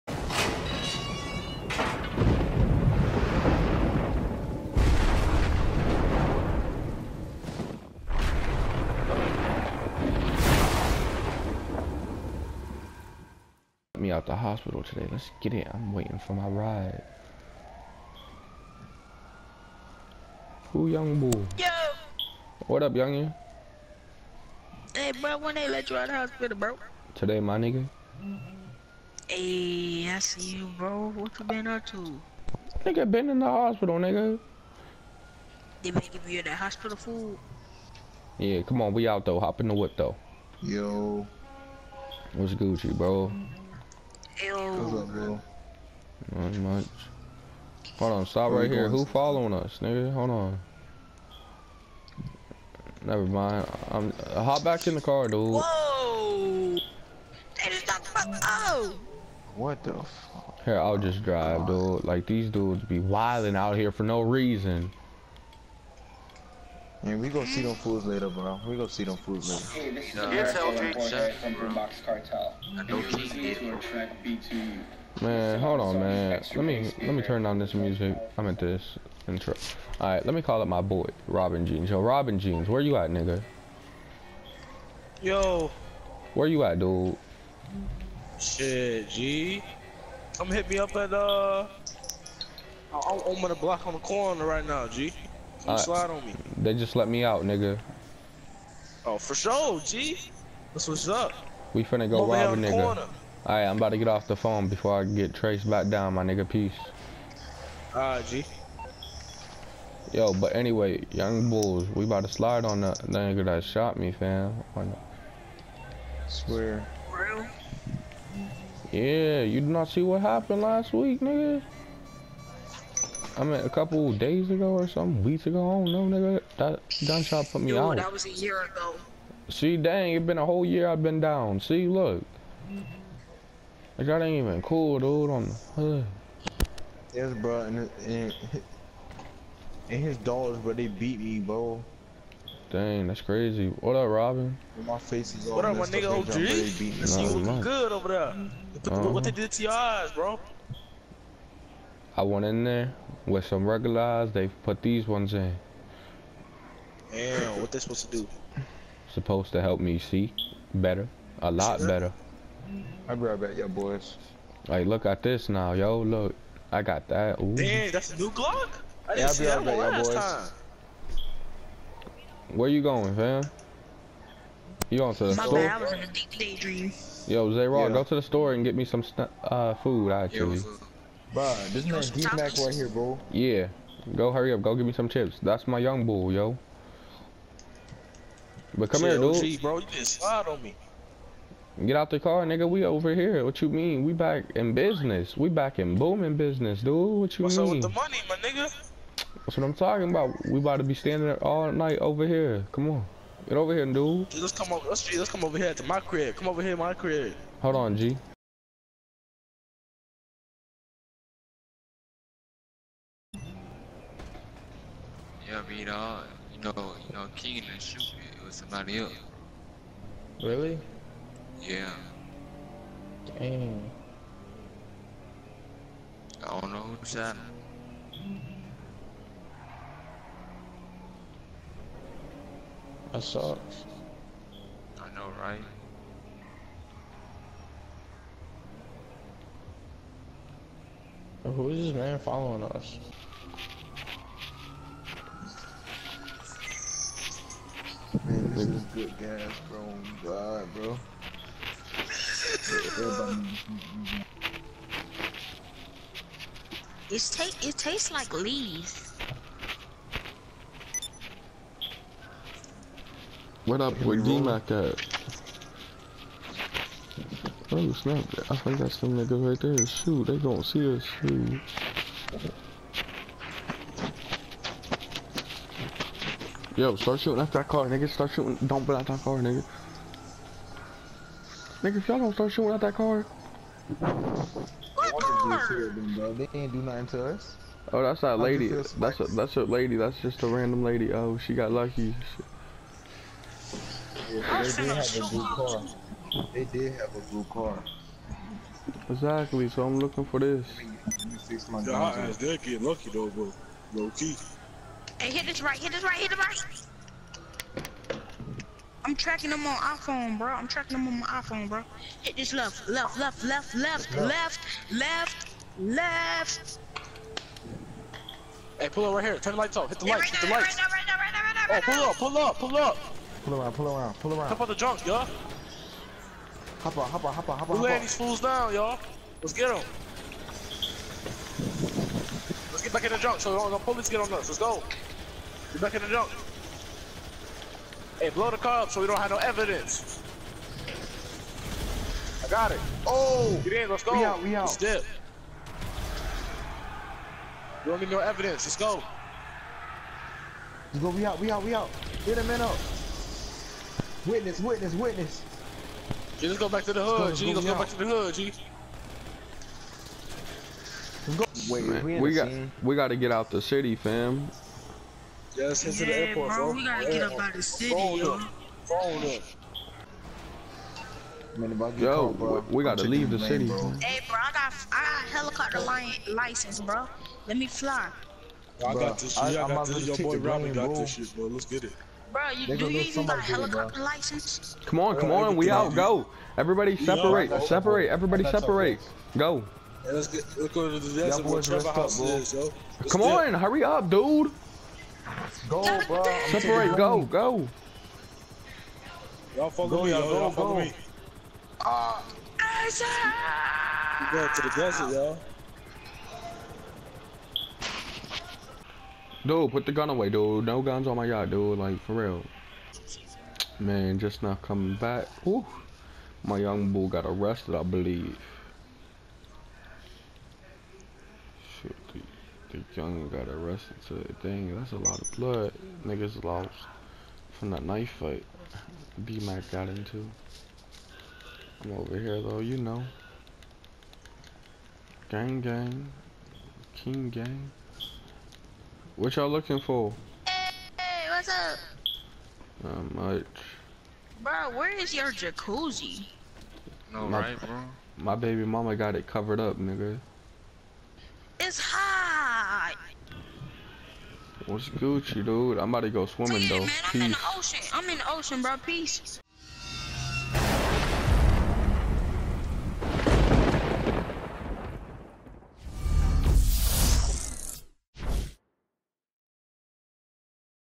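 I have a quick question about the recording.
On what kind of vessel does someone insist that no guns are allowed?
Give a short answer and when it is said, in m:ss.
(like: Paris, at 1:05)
yacht, at 6:51.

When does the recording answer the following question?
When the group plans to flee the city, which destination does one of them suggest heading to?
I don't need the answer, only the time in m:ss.
6:06.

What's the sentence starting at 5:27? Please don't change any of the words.
We're laying these fools down, y'all.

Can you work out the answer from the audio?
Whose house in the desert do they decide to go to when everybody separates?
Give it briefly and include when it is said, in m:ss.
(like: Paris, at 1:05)
Trevor, at 6:31.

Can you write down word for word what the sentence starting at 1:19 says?
All right, let me call up my boy, Robin Jeans.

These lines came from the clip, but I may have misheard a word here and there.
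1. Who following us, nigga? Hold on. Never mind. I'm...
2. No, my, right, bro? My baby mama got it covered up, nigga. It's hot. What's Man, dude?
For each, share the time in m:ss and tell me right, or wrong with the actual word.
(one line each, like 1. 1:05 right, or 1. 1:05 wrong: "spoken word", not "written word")
1. 0:48 right
2. 7:27 wrong: "Gucci", not "Man".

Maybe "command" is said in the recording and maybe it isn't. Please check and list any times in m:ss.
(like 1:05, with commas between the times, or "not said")
not said.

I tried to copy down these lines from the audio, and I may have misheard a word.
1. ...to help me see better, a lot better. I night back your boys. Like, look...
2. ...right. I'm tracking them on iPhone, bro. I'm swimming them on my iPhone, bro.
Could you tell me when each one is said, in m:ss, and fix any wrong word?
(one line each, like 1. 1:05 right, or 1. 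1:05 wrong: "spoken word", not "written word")
1. 2:39 wrong: "brought", not "night"
2. 5:06 wrong: "tracking", not "swimming".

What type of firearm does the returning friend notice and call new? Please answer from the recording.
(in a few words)
Glock.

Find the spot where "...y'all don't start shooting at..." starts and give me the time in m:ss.
4:42.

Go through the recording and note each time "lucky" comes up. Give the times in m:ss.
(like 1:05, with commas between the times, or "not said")
4:51, 5:02.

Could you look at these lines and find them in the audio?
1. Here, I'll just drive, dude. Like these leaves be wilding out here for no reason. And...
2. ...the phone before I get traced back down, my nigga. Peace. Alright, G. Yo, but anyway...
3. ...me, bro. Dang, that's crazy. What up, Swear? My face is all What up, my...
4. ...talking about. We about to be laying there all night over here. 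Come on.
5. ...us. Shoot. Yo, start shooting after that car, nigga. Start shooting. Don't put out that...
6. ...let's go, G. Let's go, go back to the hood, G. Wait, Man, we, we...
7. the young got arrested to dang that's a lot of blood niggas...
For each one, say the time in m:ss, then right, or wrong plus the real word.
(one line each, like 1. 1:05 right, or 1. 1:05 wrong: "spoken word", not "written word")
1. 1:00 wrong: "dudes", not "leaves"
2. 1:44 right
3. 2:21 wrong: "Robin", not "Swear"
4. 3:19 wrong: "standing", not "laying"
5. 4:30 right
6. 5:57 right
7. 7:02 right.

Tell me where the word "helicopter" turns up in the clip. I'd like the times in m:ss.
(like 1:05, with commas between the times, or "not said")
6:15, 6:23.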